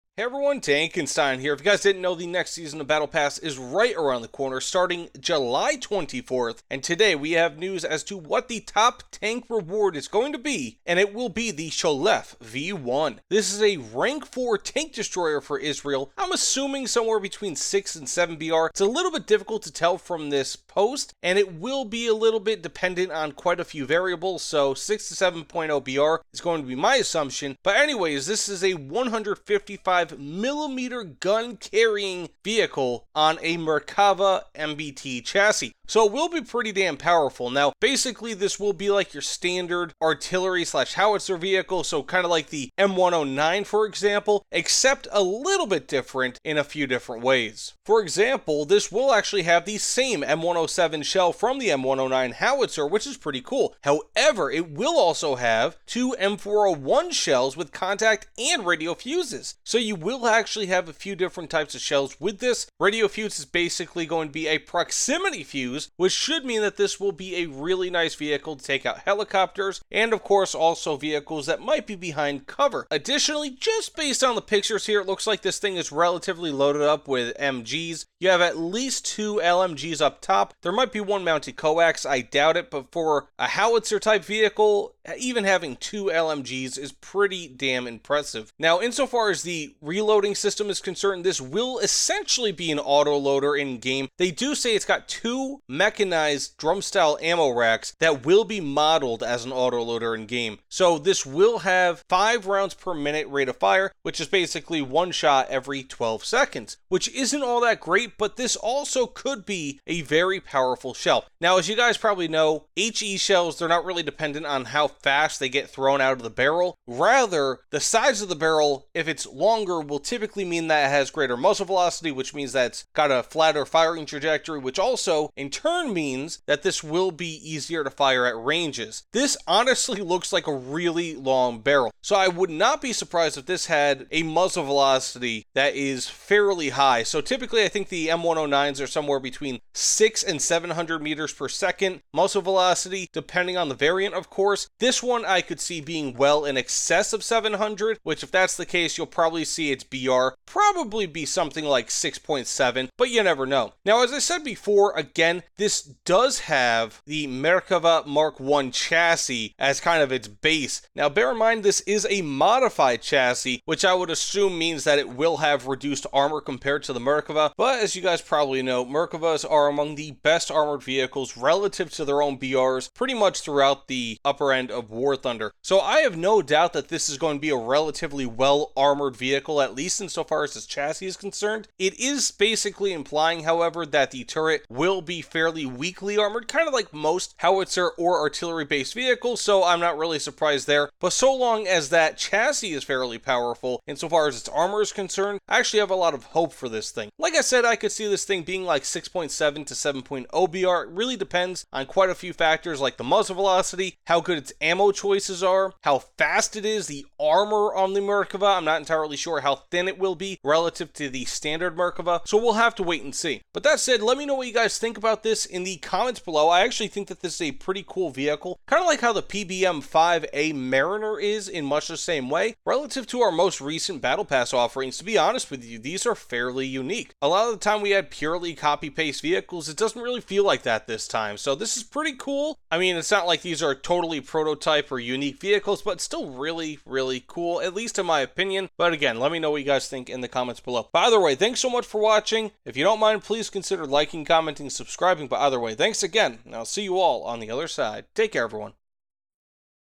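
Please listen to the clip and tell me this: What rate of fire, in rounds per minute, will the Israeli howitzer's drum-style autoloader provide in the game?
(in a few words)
5.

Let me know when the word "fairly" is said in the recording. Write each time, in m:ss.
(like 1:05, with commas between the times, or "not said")
2:16, 3:05, 3:12, 3:46.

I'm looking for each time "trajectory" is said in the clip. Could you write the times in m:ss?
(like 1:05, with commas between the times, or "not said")
2:04.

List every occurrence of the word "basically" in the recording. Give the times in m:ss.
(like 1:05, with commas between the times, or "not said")
0:37, 1:03, 1:44, 3:02.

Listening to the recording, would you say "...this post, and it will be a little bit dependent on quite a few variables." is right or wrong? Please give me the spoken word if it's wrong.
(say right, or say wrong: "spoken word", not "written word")
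right.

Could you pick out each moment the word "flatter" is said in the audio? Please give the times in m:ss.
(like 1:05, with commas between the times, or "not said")
2:03.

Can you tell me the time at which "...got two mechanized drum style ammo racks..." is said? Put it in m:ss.
1:34.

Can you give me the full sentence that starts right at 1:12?
Additionally, just based on the pictures here, it looks like this thing is relatively loaded up with MGs.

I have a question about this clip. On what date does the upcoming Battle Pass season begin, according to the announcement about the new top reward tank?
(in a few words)
July 24th.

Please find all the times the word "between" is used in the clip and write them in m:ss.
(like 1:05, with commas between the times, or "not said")
0:17, 2:19.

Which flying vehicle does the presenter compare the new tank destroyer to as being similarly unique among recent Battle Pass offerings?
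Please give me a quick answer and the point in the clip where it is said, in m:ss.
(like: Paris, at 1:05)
PBM-5A Mariner, at 3:39.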